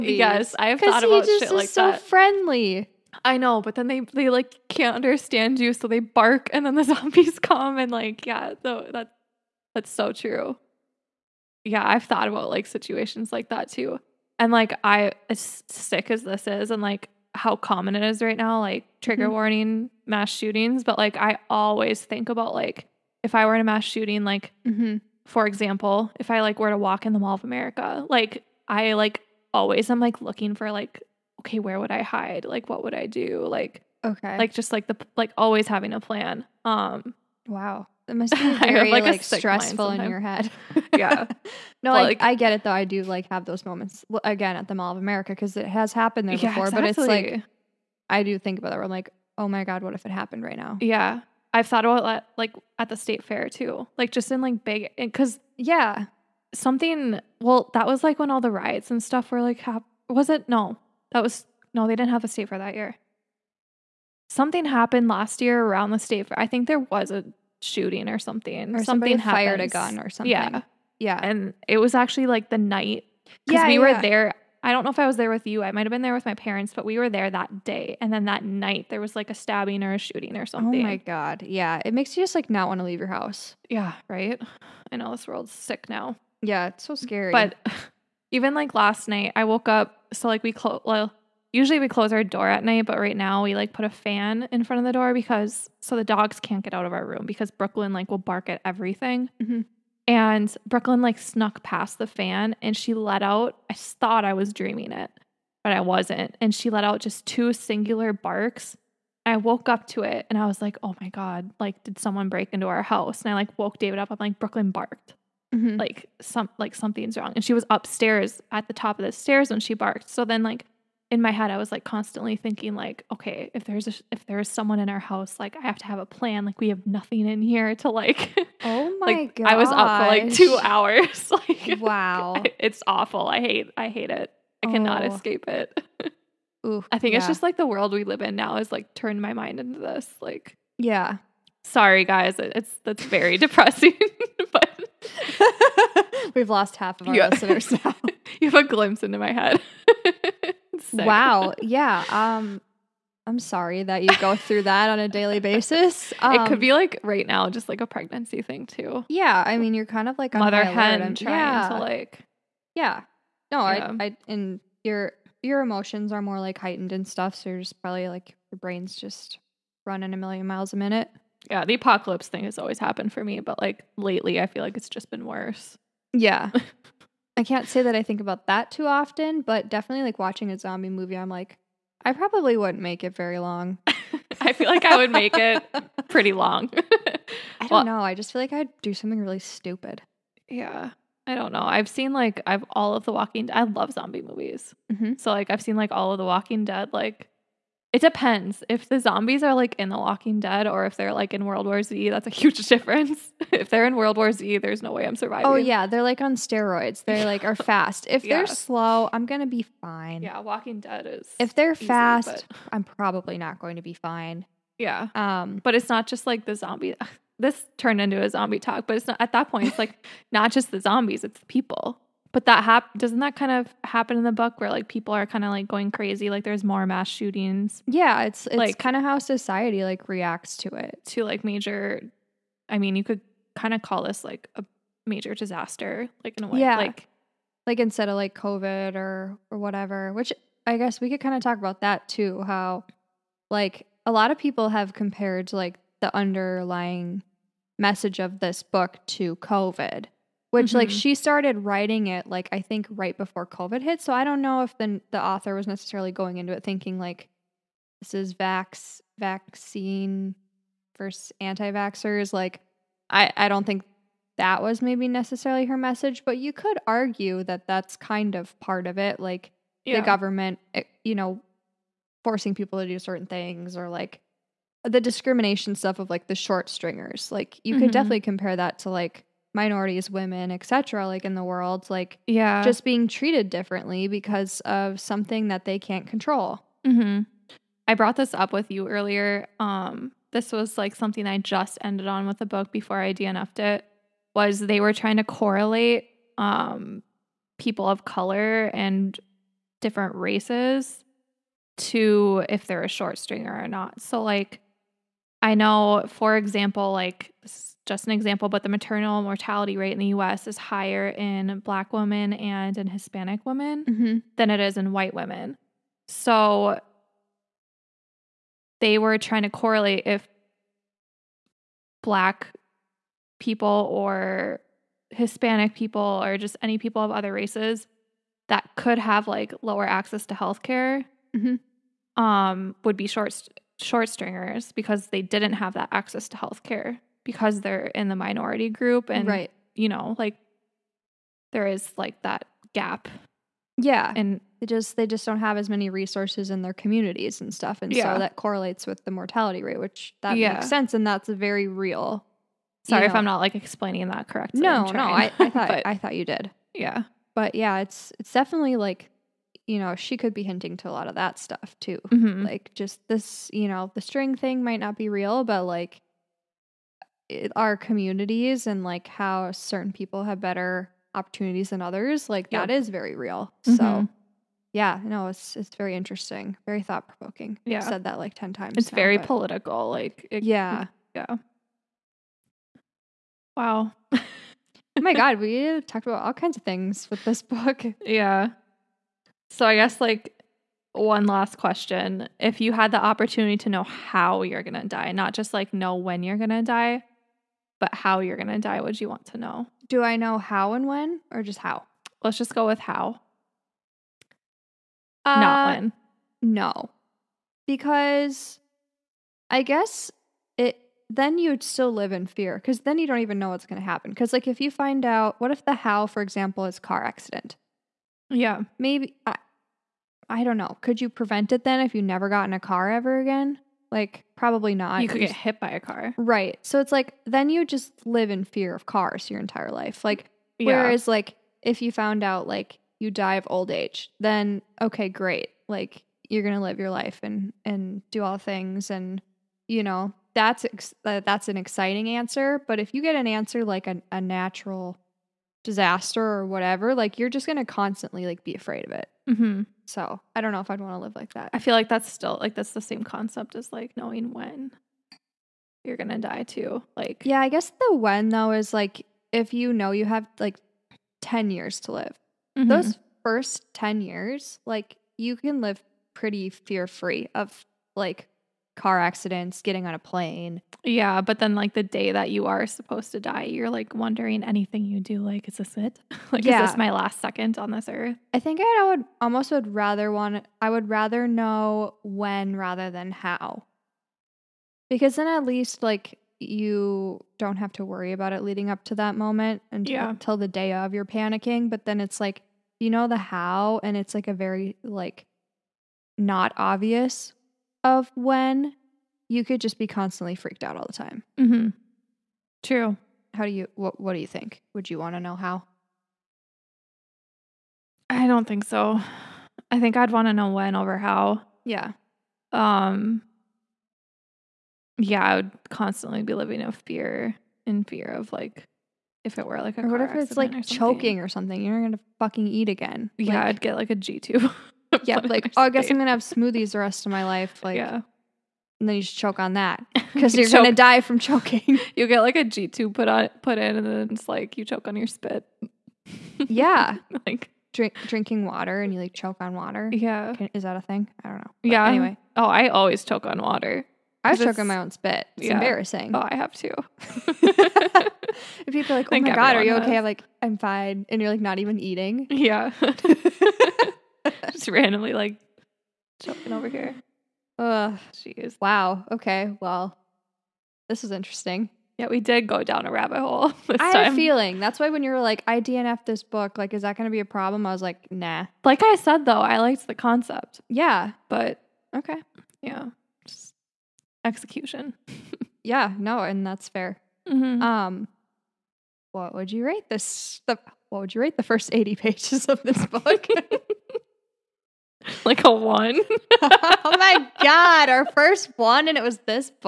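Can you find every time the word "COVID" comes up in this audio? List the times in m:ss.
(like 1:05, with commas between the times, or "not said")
3:58, 4:09, 4:13.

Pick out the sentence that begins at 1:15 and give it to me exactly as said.
I might have been there with my parents, but we were there that day.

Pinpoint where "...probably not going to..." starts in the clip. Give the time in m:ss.
3:32.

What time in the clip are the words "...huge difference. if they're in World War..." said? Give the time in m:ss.
3:22.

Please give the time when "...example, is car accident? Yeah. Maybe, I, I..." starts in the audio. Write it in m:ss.
6:56.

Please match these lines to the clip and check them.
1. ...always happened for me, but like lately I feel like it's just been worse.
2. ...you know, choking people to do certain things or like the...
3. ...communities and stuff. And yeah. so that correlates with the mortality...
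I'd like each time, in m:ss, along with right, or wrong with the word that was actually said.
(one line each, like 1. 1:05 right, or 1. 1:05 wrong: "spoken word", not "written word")
1. 2:52 right
2. 4:31 wrong: "forcing", not "choking"
3. 5:46 right.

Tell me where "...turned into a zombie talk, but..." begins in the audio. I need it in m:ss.
3:37.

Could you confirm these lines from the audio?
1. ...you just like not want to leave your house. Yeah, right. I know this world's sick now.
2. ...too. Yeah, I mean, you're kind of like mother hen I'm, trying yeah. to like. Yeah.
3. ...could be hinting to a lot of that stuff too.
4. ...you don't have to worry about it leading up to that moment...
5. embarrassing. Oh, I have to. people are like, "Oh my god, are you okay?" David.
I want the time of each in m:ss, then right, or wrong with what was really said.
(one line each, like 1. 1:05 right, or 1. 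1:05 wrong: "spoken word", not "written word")
1. 1:22 right
2. 2:38 right
3. 6:00 right
4. 8:06 right
5. 9:05 wrong: "Has", not "David".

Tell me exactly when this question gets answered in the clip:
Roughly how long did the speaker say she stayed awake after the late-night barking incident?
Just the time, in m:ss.
2:10.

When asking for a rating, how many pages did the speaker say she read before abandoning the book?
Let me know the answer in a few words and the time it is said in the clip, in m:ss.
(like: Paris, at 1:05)
80, at 9:41.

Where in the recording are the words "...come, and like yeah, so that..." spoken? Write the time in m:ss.
0:07.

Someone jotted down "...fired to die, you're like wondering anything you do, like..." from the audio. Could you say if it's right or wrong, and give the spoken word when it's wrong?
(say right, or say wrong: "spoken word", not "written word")
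wrong: "supposed", not "fired".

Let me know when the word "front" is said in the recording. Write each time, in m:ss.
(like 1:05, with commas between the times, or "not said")
1:34.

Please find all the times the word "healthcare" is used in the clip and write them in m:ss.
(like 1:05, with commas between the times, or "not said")
5:30, 5:36.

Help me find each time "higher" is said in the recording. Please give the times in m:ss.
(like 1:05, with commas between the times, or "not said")
5:10.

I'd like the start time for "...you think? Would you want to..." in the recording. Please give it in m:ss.
8:24.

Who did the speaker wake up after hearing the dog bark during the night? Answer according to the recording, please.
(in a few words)
David.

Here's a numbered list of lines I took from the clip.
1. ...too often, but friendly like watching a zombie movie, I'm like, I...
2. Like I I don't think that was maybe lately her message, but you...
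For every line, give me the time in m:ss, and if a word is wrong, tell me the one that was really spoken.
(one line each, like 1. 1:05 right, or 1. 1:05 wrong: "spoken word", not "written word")
1. 2:58 wrong: "definitely", not "friendly"
2. 4:22 wrong: "necessarily", not "lately".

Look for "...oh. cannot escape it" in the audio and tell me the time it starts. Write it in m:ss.
2:14.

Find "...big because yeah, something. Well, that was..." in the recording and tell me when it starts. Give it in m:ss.
0:54.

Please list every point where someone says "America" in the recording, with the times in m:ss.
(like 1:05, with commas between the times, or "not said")
0:27, 0:44.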